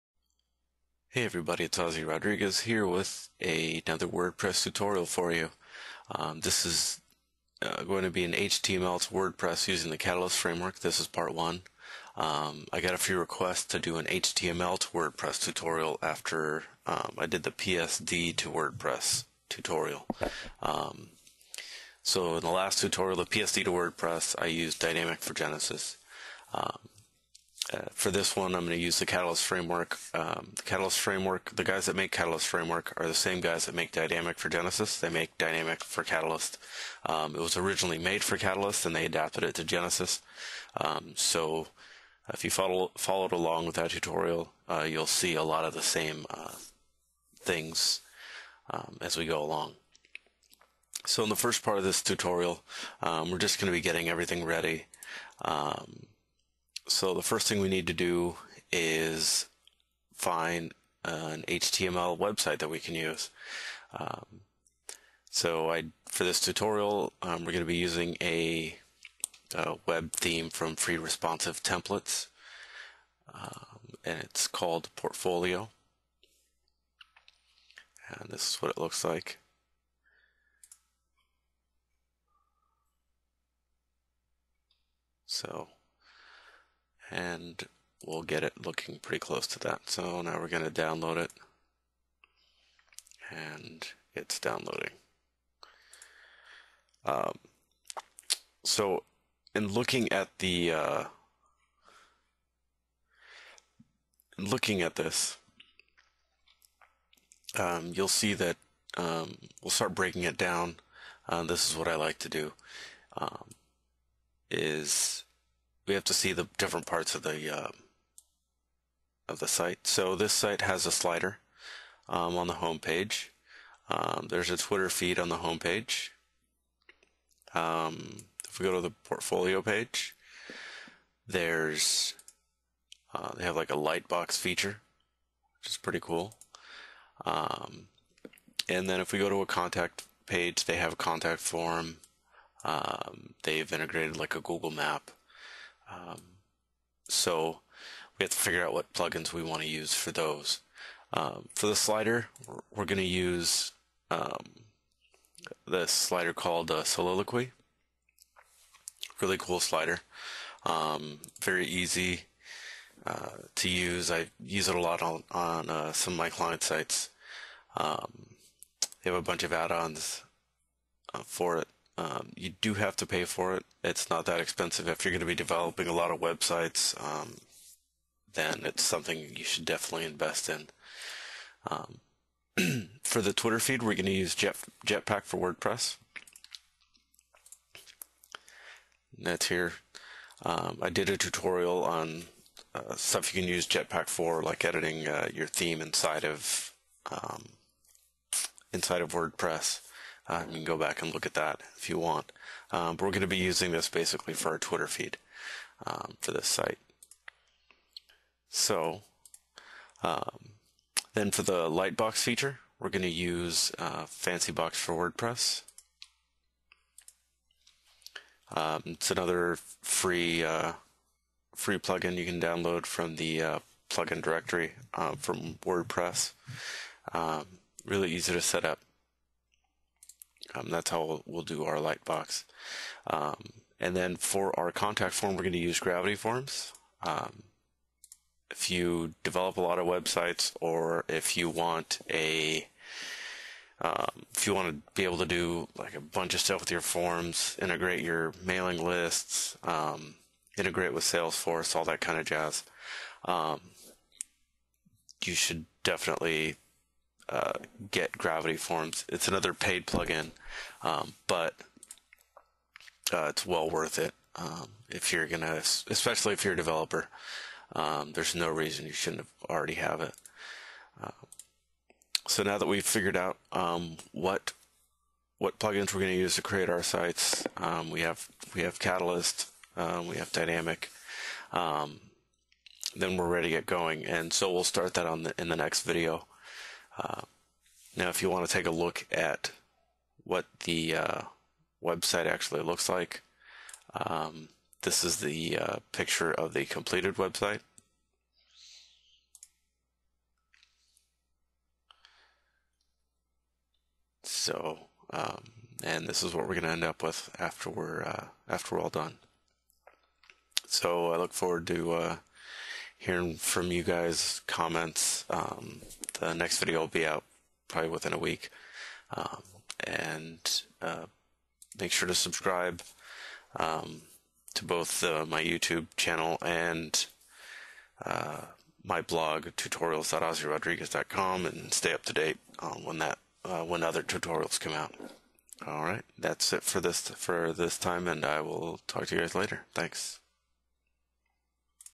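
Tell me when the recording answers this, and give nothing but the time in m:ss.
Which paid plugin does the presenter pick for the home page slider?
2:36.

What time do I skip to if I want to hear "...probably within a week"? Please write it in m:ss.
5:17.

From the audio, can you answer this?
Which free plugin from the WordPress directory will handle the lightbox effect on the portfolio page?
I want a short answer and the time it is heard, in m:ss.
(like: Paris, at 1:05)
Fancybox, at 3:34.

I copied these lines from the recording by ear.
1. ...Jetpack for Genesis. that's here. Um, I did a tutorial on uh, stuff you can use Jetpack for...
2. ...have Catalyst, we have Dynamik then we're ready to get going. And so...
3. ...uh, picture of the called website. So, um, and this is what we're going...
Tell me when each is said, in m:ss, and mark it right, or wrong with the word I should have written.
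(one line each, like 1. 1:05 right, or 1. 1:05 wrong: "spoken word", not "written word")
1. 3:04 wrong: "WordPress", not "Genesis"
2. 4:38 right
3. 4:55 wrong: "completed", not "called".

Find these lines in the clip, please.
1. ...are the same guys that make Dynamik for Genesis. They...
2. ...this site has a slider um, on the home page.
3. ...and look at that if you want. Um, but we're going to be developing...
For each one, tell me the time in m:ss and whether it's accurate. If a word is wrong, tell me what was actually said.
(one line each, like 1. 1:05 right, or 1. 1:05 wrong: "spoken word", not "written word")
1. 0:32 right
2. 2:00 right
3. 3:21 wrong: "using", not "developing".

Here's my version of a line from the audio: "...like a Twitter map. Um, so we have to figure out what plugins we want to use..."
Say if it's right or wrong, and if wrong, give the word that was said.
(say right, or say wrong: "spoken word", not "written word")
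wrong: "Google", not "Twitter".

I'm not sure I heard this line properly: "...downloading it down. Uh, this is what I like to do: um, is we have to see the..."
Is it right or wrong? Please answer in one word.
wrong.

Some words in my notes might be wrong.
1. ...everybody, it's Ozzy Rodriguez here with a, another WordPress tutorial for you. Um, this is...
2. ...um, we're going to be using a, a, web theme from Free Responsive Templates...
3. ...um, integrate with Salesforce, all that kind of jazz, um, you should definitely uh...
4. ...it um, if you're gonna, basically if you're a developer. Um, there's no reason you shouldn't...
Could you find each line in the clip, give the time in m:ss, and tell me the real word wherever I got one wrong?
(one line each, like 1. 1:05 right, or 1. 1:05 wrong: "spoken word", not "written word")
1. 0:01 right
2. 1:07 right
3. 4:09 right
4. 4:23 wrong: "especially", not "basically".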